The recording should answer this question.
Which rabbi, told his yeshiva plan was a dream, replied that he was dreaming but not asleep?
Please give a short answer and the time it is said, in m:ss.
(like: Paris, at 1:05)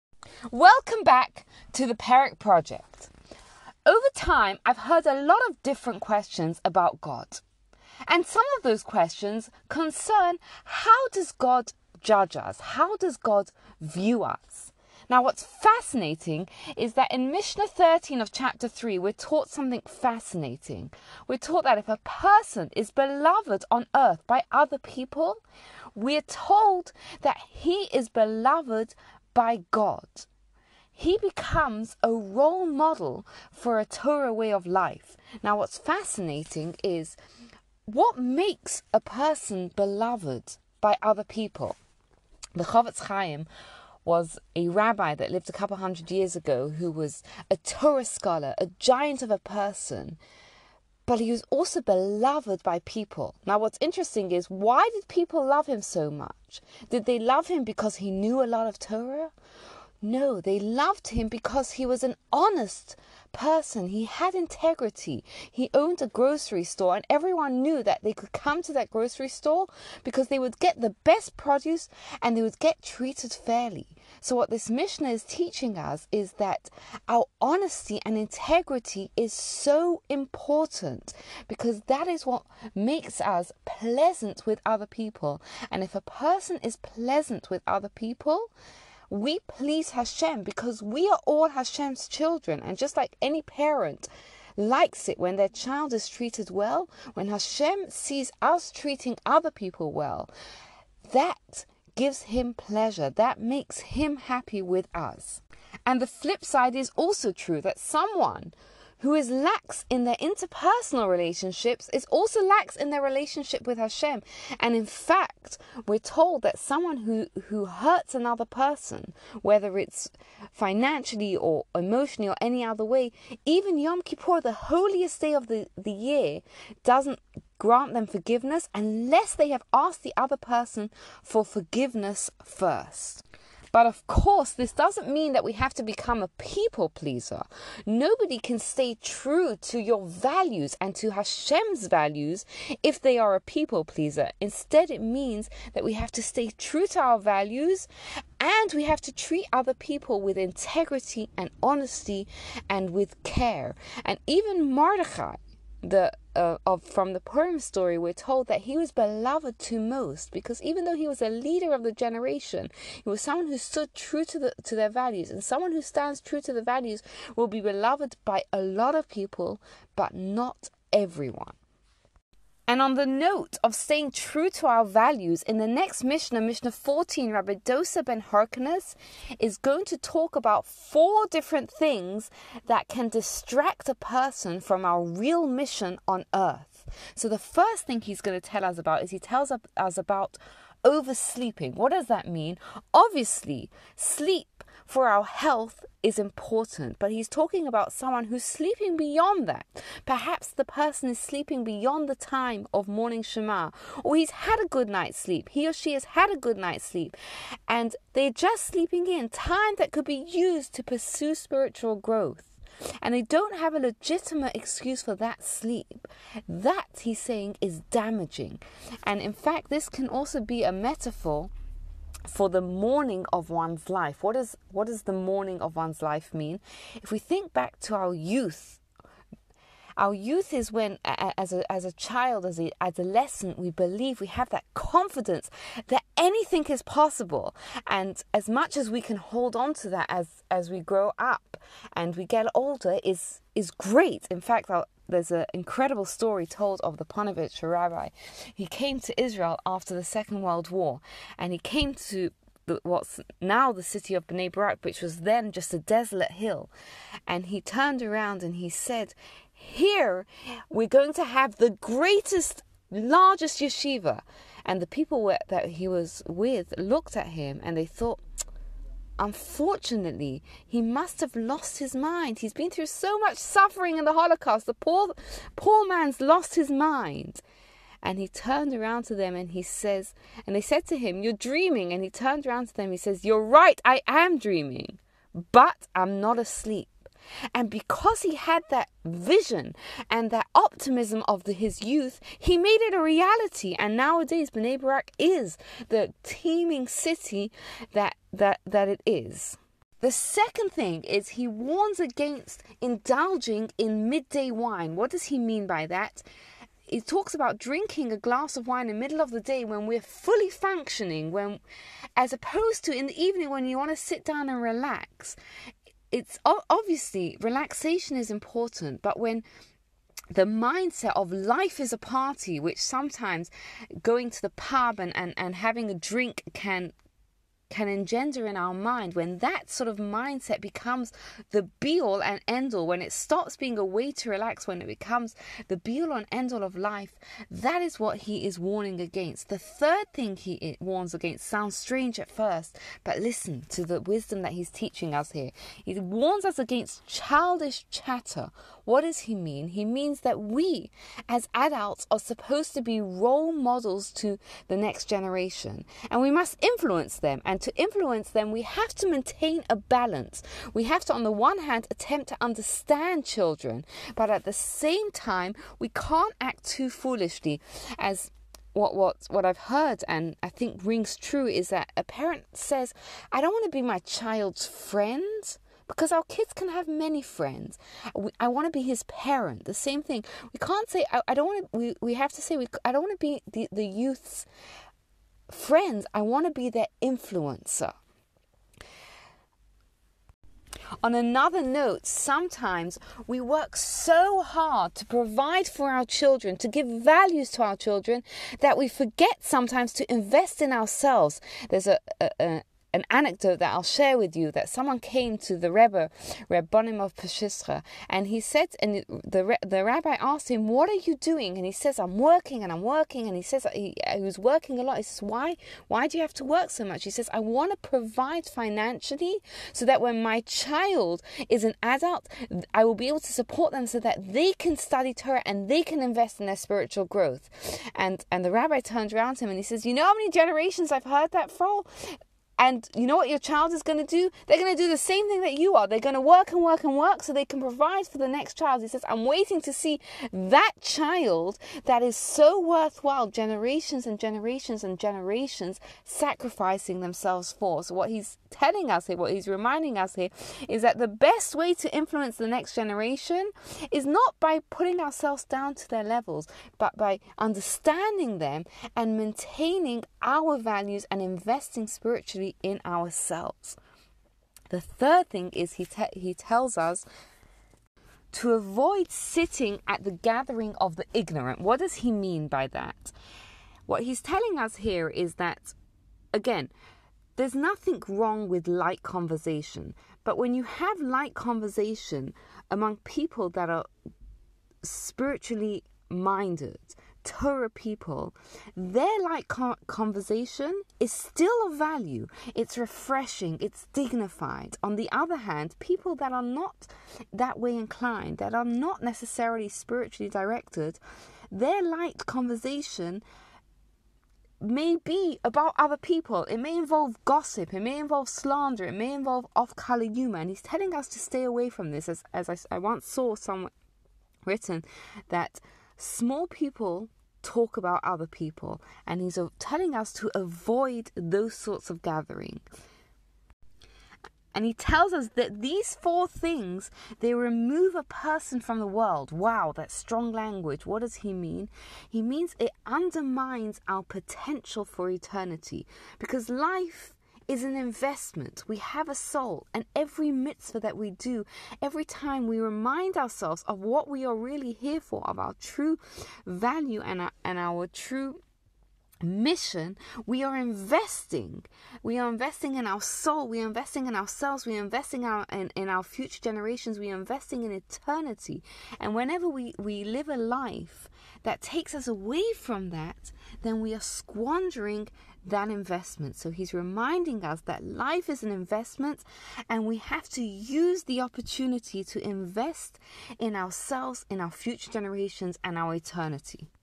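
Ponevezh rabbi, at 4:06.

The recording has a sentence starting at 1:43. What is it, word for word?
That makes him happy with us.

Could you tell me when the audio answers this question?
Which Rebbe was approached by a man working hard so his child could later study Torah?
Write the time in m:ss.
6:46.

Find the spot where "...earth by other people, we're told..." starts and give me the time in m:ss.
0:23.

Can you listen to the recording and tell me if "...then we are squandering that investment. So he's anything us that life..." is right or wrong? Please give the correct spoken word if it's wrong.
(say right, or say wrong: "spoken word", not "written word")
wrong: "reminding", not "anything".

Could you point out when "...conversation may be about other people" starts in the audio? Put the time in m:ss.
8:22.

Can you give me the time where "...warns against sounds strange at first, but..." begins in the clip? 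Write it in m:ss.
5:40.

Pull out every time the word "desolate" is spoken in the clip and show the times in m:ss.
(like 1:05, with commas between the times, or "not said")
4:15.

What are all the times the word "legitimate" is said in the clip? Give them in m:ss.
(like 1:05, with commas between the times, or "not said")
3:33.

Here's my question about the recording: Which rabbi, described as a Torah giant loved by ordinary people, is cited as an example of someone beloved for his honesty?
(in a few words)
Chofetz Chaim.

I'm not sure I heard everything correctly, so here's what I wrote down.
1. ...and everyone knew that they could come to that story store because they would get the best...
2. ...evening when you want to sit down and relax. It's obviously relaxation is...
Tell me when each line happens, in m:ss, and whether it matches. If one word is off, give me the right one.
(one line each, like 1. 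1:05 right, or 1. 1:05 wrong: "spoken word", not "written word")
1. 1:06 wrong: "grocery", not "story"
2. 5:13 right.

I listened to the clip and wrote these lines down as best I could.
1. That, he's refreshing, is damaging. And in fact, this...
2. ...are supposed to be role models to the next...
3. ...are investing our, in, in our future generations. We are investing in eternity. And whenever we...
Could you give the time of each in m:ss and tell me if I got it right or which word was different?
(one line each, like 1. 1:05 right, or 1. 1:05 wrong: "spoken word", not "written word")
1. 3:36 wrong: "saying", not "refreshing"
2. 5:52 right
3. 9:14 right.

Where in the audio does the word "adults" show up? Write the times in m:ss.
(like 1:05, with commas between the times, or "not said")
5:51, 7:01.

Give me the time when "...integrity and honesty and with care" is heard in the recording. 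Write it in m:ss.
2:30.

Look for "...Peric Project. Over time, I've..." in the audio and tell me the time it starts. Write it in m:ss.
0:01.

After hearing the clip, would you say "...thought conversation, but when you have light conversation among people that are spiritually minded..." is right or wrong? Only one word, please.
wrong.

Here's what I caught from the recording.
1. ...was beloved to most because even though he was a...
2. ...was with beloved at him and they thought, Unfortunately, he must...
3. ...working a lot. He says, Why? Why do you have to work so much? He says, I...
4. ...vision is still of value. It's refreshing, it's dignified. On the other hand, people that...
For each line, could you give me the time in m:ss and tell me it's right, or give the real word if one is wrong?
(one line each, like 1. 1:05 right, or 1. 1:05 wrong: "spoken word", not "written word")
1. 2:38 right
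2. 4:25 wrong: "looked", not "beloved"
3. 6:54 right
4. 8:09 wrong: "conversation", not "vision".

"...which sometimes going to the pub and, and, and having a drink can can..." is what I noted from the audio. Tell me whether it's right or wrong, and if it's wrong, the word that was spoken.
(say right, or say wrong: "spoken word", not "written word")
right.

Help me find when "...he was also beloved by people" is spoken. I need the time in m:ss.
0:51.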